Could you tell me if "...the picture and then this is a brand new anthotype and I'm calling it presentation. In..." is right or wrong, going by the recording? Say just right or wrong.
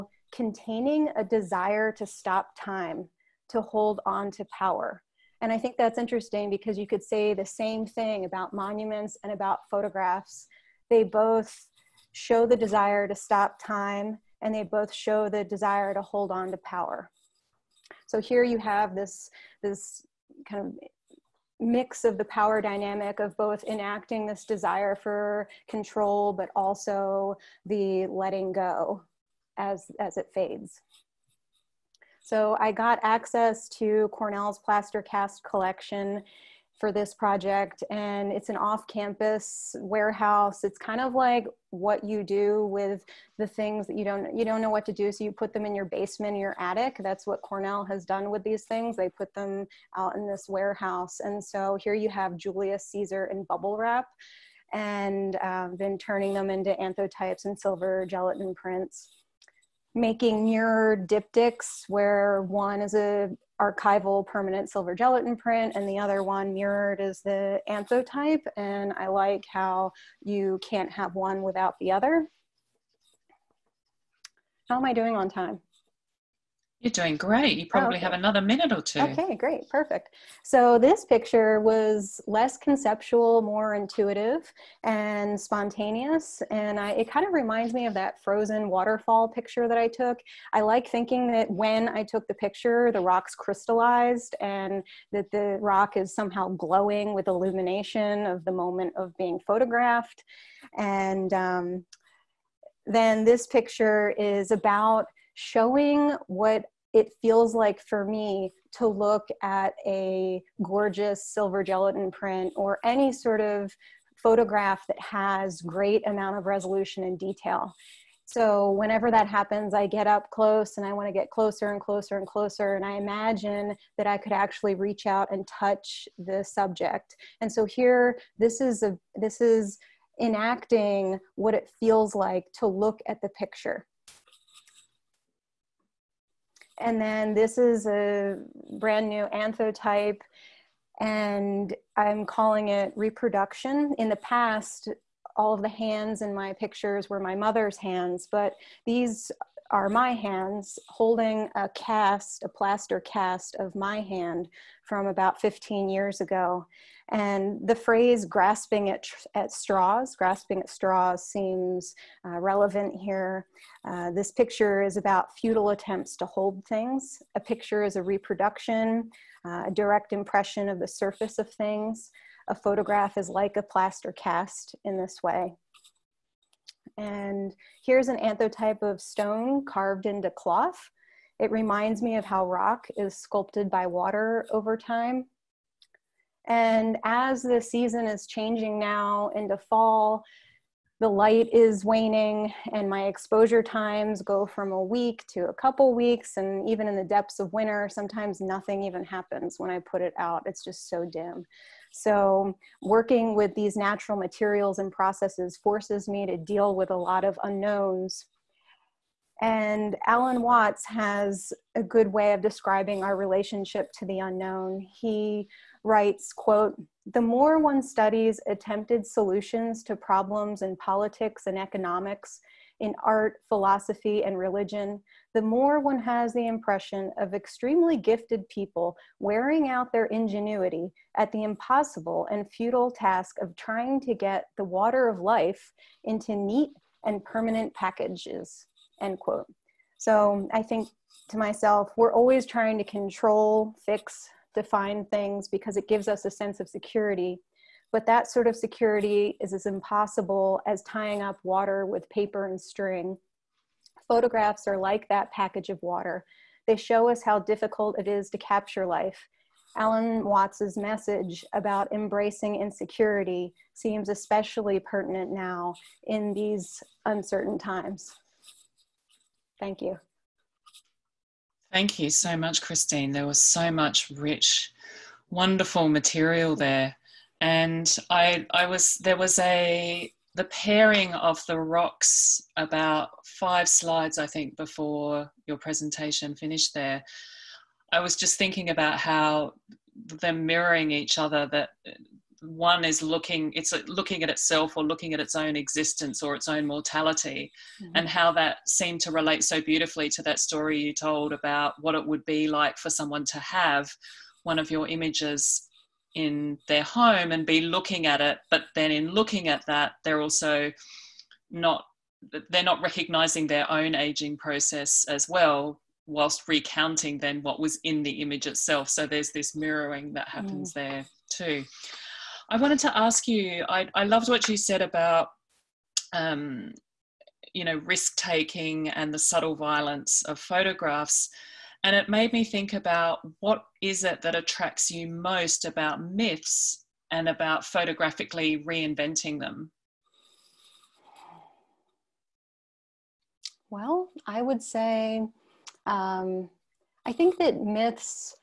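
wrong.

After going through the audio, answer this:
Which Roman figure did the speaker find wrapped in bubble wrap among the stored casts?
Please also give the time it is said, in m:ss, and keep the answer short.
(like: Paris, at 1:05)
Julius Caesar, at 0:52.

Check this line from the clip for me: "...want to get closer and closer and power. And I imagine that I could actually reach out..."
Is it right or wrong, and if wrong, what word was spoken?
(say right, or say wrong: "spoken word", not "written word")
wrong: "closer", not "power".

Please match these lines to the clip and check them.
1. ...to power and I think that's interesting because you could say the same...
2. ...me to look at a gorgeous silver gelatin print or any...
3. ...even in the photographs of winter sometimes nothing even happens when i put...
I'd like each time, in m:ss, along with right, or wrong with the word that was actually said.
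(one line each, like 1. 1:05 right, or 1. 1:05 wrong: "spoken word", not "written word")
1. 0:04 right
2. 1:48 right
3. 3:16 wrong: "depths", not "photographs".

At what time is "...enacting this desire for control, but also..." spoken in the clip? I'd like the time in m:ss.
0:23.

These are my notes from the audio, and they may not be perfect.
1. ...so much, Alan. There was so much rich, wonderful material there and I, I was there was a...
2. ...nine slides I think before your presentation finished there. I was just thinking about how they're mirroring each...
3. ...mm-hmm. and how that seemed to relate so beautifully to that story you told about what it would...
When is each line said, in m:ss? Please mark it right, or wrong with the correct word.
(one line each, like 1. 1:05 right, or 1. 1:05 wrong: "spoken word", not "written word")
1. 4:32 wrong: "Christine", not "Alan"
2. 4:43 wrong: "five", not "nine"
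3. 4:57 right.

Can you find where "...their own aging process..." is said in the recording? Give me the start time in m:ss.
5:13.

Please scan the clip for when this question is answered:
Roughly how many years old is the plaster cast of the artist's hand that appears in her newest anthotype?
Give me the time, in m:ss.
2:35.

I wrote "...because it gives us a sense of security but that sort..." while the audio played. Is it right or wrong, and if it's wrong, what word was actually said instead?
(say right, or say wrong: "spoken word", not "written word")
right.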